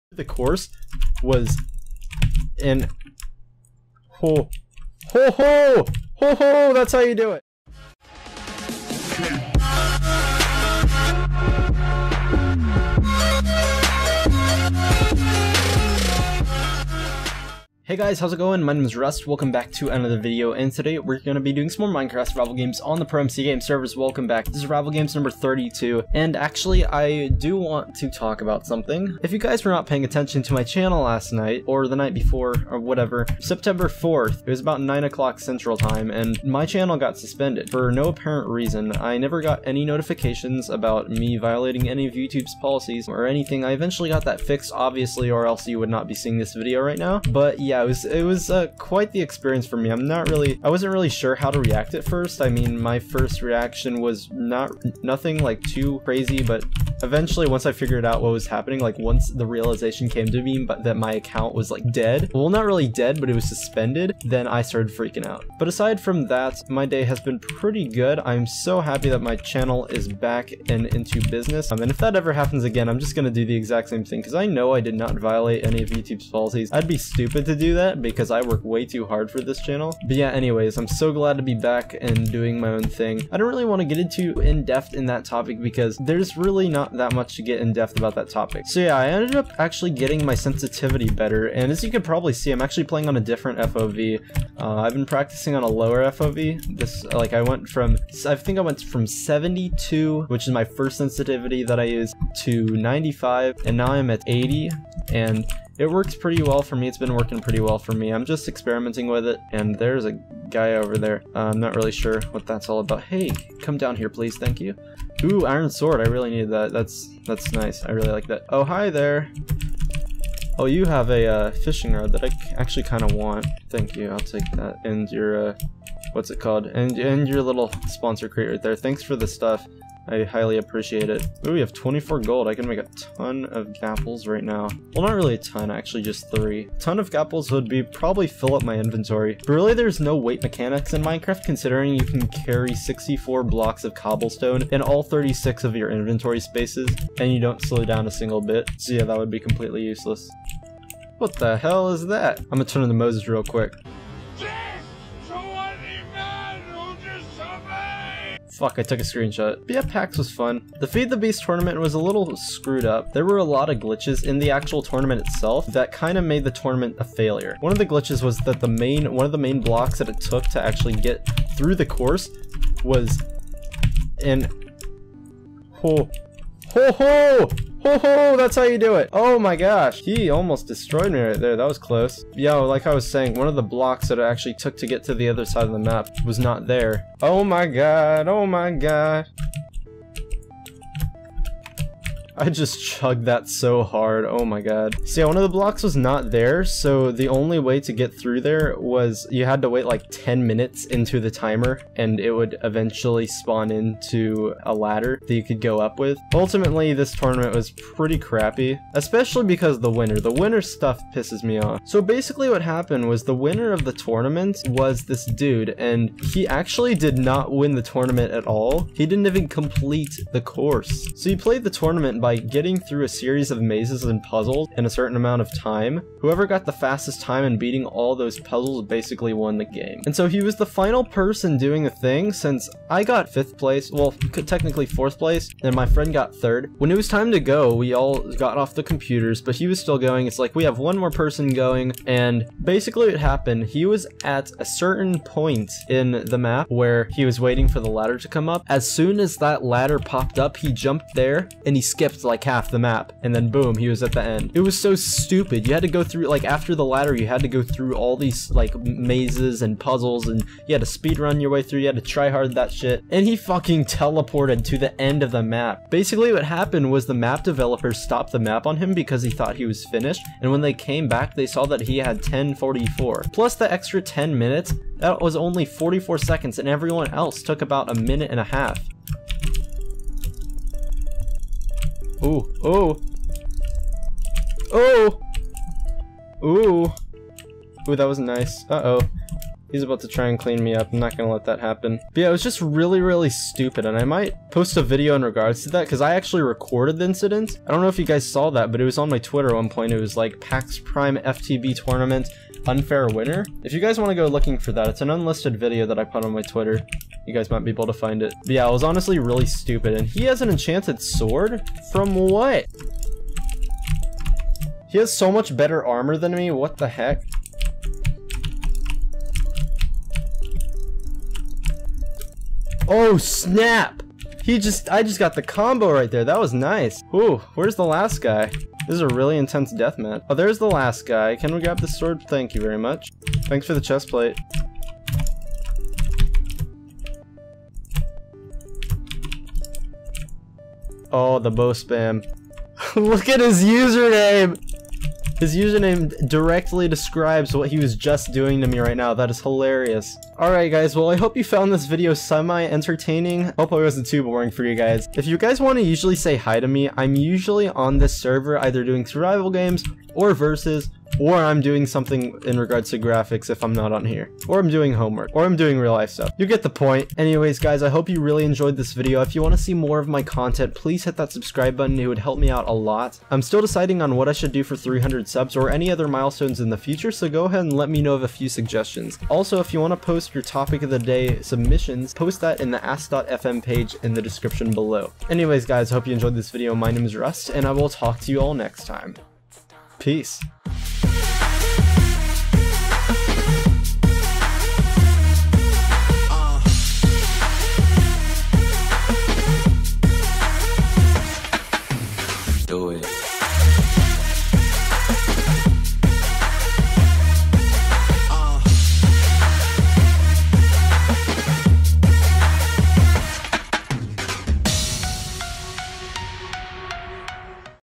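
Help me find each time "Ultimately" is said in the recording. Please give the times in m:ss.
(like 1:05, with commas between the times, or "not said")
3:26.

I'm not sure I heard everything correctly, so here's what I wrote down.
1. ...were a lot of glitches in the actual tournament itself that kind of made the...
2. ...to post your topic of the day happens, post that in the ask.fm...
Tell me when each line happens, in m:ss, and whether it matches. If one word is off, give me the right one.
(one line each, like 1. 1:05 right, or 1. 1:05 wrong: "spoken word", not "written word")
1. 2:43 right
2. 6:19 wrong: "submissions", not "happens".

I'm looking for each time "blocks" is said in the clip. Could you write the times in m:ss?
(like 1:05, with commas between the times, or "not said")
2:23, 2:49, 3:03, 3:15.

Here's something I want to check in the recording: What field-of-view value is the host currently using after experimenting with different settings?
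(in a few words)
80.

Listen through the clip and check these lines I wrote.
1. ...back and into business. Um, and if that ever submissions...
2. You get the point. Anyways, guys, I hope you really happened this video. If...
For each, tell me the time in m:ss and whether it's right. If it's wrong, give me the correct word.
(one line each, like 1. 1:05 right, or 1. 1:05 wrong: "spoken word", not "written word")
1. 1:10 wrong: "happens", not "submissions"
2. 6:06 wrong: "enjoyed", not "happened".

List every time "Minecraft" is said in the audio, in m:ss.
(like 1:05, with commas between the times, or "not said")
0:22, 2:21.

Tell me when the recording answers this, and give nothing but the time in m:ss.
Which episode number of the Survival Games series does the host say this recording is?
0:25.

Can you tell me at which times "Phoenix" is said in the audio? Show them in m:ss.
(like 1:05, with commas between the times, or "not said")
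not said.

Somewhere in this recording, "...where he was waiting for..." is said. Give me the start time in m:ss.
4:06.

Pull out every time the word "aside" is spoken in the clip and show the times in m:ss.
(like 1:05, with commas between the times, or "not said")
1:05.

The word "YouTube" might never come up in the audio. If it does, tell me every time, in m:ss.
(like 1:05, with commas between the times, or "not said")
0:42, 1:15.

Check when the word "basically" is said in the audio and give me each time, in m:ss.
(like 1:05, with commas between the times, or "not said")
3:32, 3:48, 4:02, 4:25.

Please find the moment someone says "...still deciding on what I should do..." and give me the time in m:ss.
6:13.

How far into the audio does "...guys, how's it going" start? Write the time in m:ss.
0:17.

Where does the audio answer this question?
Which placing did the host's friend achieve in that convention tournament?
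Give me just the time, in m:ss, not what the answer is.
3:56.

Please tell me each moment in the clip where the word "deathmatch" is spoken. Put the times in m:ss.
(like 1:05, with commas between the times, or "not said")
5:29.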